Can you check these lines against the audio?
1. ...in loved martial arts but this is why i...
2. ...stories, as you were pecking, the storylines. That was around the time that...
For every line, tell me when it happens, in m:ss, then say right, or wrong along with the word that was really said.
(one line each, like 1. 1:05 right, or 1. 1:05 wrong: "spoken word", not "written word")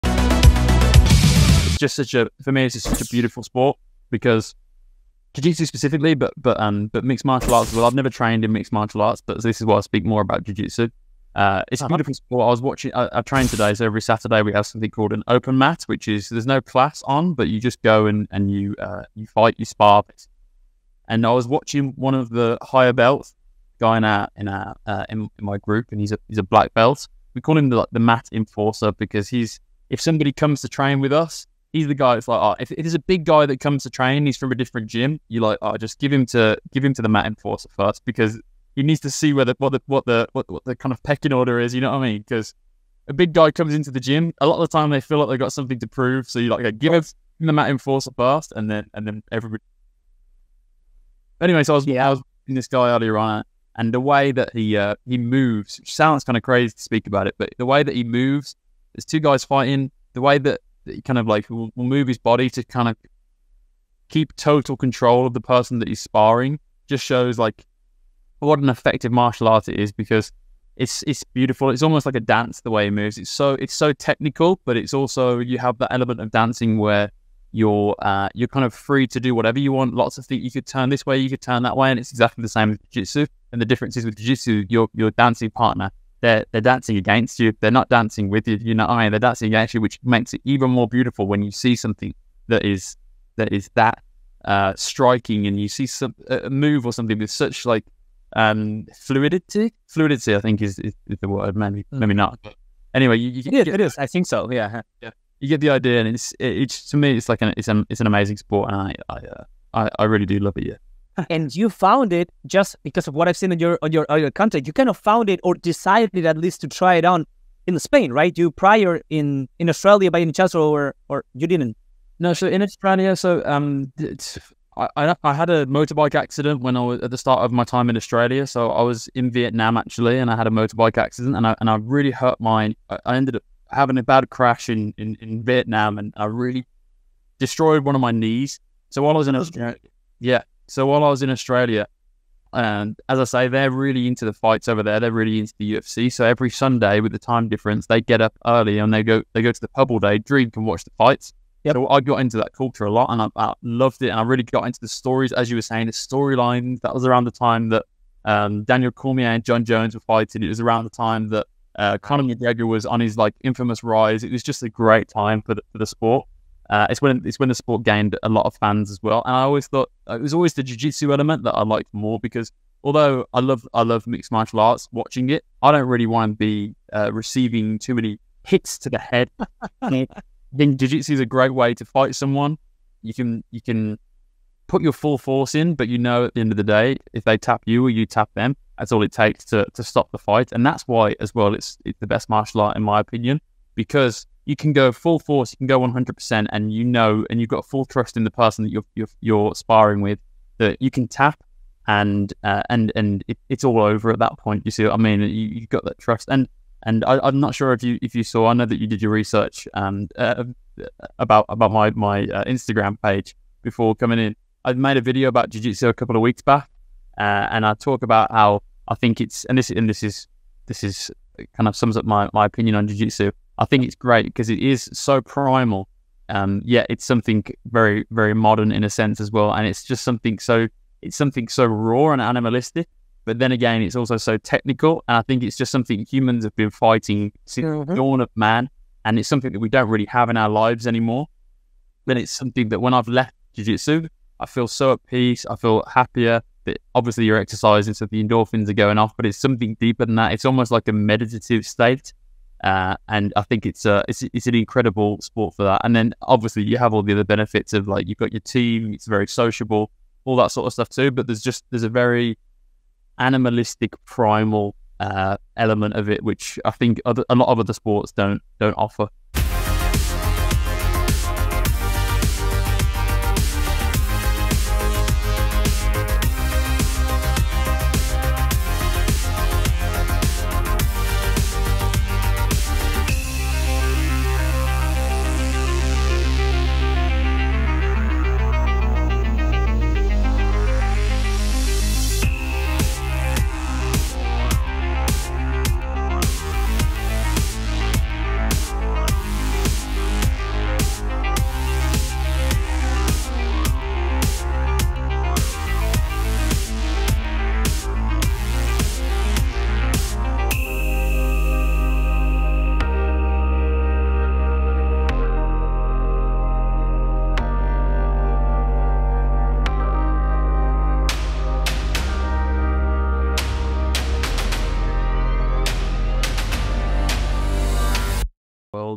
1. 0:08 wrong: "mixed", not "loved"
2. 2:34 wrong: "saying", not "pecking".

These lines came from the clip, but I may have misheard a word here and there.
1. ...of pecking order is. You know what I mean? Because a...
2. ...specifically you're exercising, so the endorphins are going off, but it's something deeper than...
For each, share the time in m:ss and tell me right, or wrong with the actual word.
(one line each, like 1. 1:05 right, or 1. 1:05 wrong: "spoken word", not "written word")
1. 0:40 right
2. 4:06 wrong: "obviously", not "specifically".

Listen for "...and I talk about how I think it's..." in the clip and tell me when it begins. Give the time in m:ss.
3:37.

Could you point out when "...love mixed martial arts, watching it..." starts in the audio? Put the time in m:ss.
2:53.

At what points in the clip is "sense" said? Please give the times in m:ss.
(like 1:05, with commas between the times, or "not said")
3:48.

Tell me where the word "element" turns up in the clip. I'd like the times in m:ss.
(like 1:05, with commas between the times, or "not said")
1:15, 2:51, 4:25.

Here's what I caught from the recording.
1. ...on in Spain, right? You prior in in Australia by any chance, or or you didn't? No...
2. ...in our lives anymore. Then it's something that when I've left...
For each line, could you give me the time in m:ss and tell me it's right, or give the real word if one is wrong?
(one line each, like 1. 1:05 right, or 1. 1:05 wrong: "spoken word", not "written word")
1. 1:57 right
2. 4:00 right.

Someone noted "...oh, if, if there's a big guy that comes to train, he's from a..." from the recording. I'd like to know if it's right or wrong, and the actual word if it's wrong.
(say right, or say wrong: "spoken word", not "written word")
right.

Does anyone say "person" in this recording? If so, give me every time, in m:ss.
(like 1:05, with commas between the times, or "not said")
1:05, 3:18.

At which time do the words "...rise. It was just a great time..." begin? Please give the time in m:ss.
2:43.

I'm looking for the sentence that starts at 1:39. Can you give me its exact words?
Fluidity, I think, is, is, is the word.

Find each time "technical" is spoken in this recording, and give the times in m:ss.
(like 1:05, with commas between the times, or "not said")
1:13, 3:54.